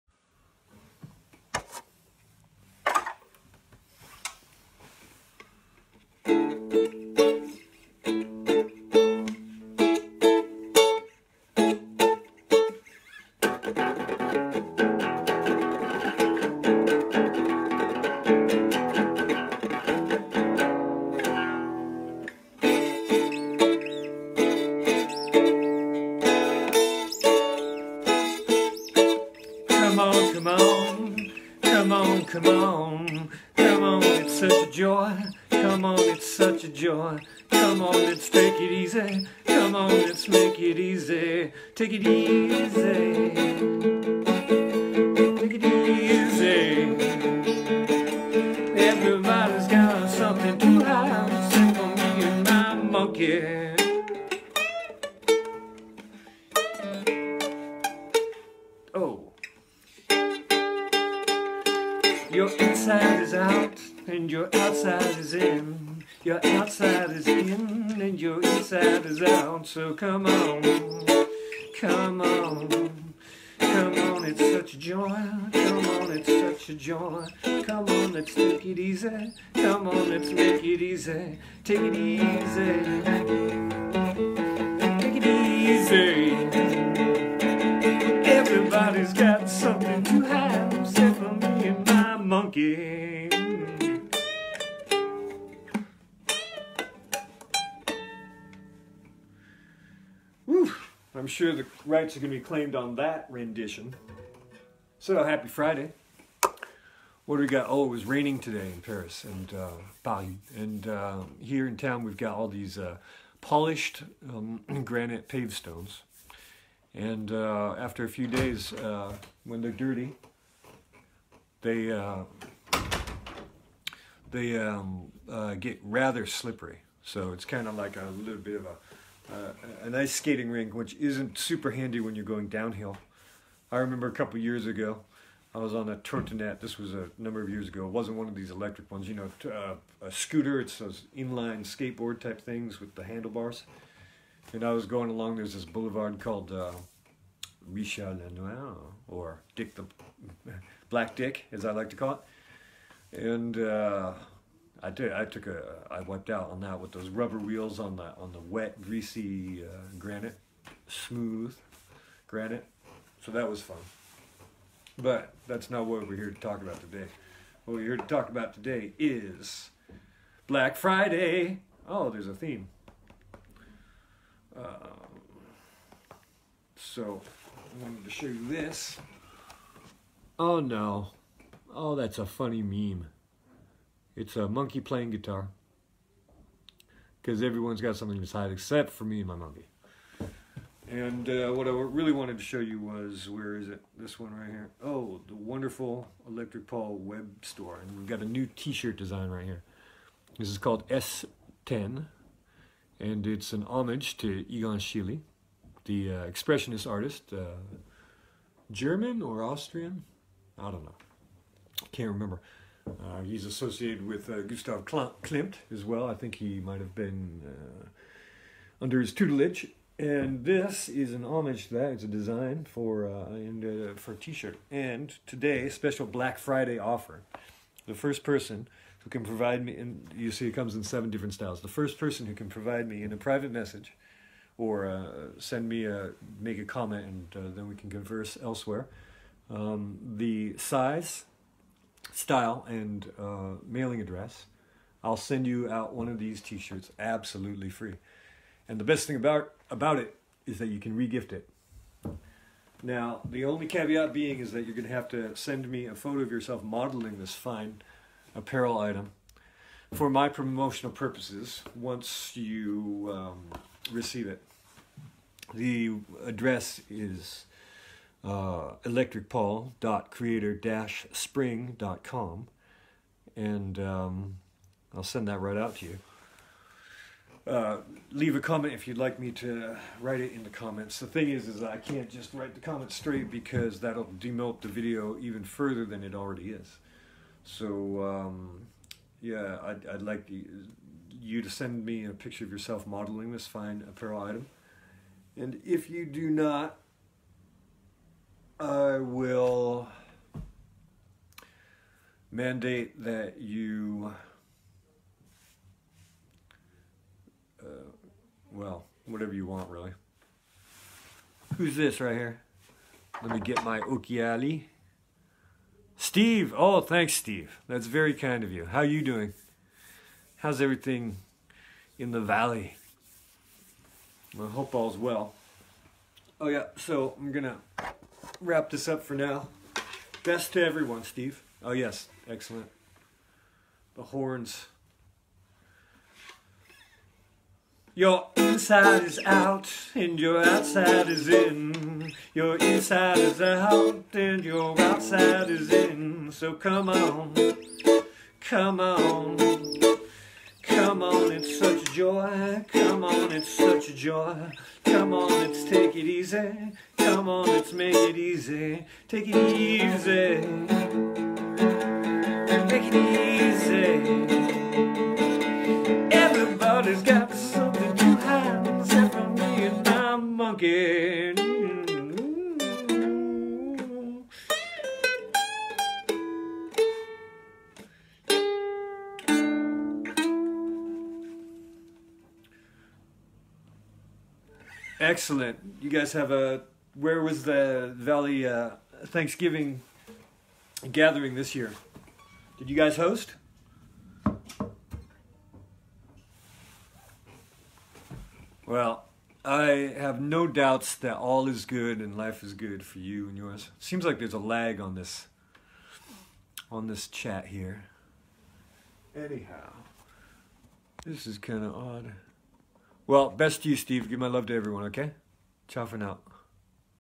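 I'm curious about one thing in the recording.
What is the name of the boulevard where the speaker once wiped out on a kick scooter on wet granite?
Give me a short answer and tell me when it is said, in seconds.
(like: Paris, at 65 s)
Richard Lenoir, at 147 s.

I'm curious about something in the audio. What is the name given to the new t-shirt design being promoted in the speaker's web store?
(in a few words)
S10.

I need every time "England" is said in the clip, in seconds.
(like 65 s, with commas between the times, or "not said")
not said.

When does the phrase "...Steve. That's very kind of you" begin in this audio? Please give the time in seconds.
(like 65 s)
317 s.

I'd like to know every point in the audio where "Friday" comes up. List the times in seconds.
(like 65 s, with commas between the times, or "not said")
105 s, 170 s, 226 s.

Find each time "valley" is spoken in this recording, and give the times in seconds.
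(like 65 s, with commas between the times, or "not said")
322 s, 387 s.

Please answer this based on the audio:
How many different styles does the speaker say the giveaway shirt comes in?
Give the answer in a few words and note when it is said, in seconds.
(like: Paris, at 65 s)
7, at 230 s.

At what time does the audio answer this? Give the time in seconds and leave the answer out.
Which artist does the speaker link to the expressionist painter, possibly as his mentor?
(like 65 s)
214 s.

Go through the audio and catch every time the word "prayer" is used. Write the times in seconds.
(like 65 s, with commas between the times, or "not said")
not said.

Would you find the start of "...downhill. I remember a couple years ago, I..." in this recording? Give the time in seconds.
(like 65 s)
132 s.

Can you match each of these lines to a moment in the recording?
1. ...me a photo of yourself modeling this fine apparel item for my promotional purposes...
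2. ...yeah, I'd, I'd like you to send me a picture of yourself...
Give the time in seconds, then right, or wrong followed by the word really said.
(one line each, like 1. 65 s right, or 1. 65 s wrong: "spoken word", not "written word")
1. 255 s right
2. 289 s right.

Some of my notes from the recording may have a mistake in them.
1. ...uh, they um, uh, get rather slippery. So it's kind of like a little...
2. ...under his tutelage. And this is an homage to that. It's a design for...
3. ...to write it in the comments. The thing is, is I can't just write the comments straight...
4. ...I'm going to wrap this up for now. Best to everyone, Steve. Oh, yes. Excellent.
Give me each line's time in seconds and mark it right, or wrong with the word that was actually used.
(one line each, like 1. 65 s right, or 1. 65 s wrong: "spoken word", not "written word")
1. 121 s right
2. 218 s right
3. 279 s right
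4. 327 s right.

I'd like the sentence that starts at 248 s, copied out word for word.
And the best thing about, about it is that you can regift it.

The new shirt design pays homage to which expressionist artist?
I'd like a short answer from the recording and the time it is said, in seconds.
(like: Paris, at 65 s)
Egon Schiele, at 204 s.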